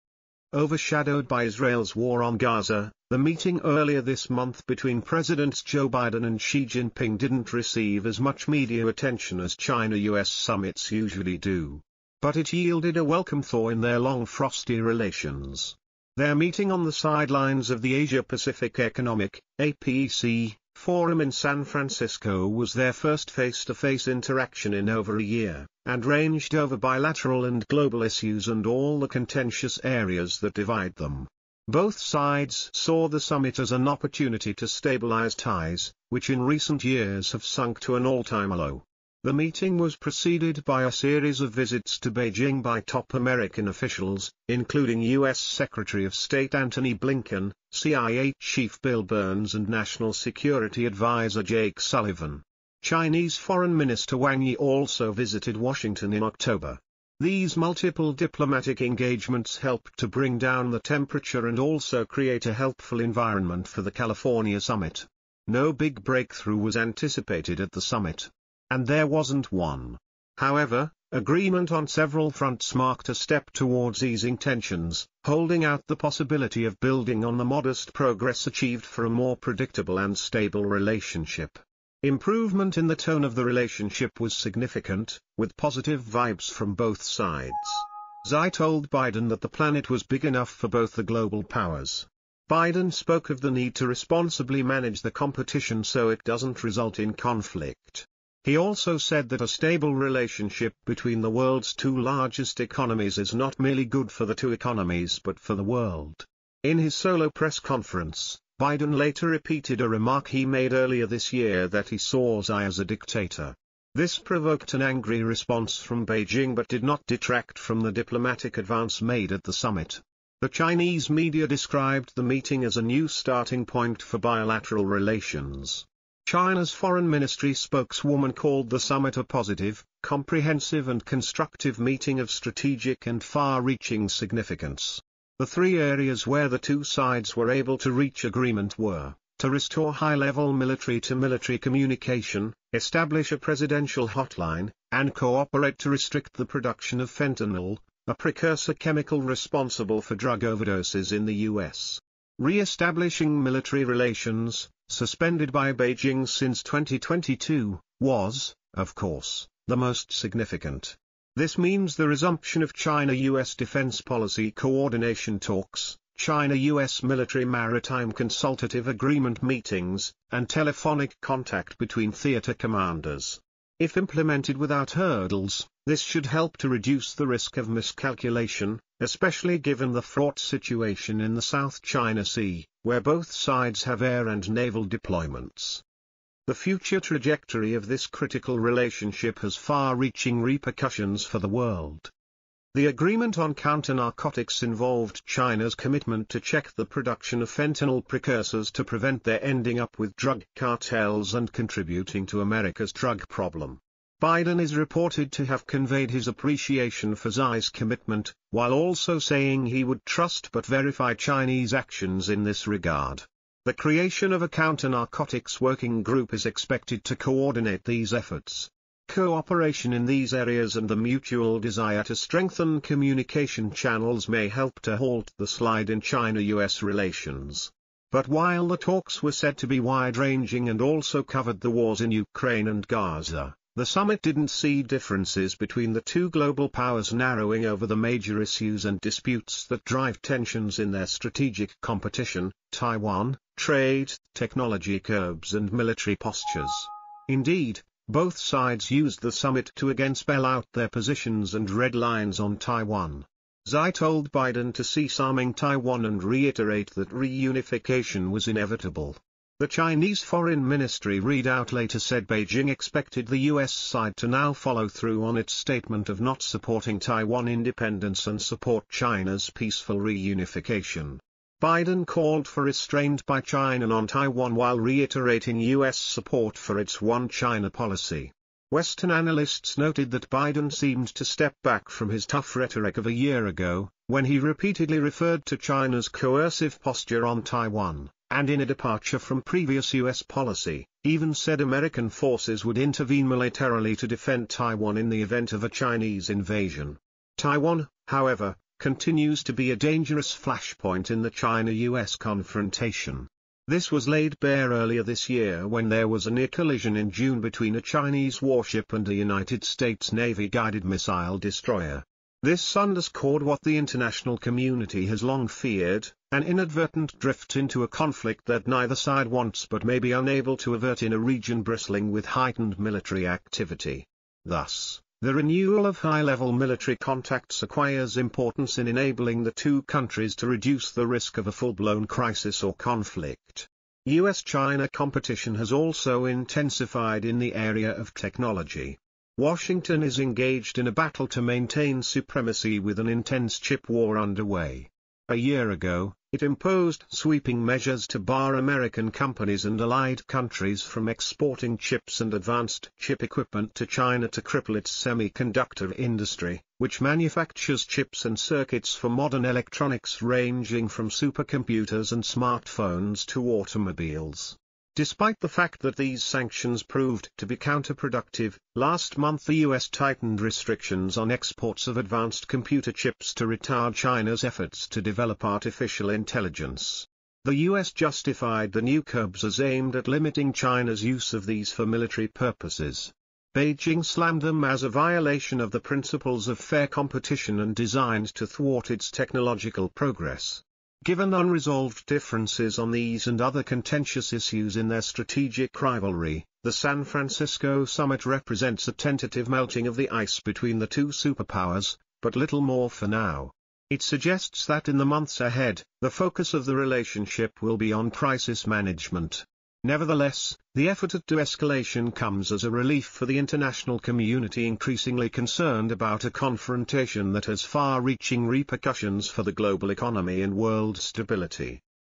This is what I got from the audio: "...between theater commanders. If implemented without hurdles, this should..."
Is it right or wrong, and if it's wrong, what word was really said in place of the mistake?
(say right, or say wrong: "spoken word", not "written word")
right.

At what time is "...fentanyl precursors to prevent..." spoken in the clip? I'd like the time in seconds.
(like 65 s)
197 s.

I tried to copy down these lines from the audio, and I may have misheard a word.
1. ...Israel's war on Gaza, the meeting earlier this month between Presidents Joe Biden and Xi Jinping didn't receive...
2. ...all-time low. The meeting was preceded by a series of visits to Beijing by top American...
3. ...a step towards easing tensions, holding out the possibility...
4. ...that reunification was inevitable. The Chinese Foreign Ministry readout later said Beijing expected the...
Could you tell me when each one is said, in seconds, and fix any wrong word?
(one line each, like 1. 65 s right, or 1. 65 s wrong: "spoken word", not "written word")
1. 1 s right
2. 38 s right
3. 73 s right
4. 256 s right.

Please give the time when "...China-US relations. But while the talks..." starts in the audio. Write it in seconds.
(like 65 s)
225 s.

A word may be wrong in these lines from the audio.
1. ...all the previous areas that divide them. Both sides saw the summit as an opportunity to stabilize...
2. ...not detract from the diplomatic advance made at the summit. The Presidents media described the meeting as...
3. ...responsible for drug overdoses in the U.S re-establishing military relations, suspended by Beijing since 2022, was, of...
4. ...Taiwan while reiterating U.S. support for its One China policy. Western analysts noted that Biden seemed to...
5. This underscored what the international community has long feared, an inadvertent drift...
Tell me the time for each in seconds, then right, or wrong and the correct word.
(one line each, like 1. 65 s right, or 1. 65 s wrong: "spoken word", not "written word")
1. 28 s wrong: "contentious", not "previous"
2. 116 s wrong: "Chinese", not "Presidents"
3. 149 s right
4. 274 s right
5. 312 s right.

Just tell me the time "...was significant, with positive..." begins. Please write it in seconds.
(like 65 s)
84 s.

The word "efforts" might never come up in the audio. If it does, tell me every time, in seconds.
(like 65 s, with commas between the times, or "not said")
218 s, 374 s, 410 s.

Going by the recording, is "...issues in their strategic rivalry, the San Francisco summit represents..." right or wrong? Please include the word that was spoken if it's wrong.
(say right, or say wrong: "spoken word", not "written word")
right.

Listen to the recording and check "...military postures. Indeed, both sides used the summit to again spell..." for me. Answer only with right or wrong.
right.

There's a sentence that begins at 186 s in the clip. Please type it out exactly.
The future trajectory of this critical relationship has far-reaching repercussions for the world.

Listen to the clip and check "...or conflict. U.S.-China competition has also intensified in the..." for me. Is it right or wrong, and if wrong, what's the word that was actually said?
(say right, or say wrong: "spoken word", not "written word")
right.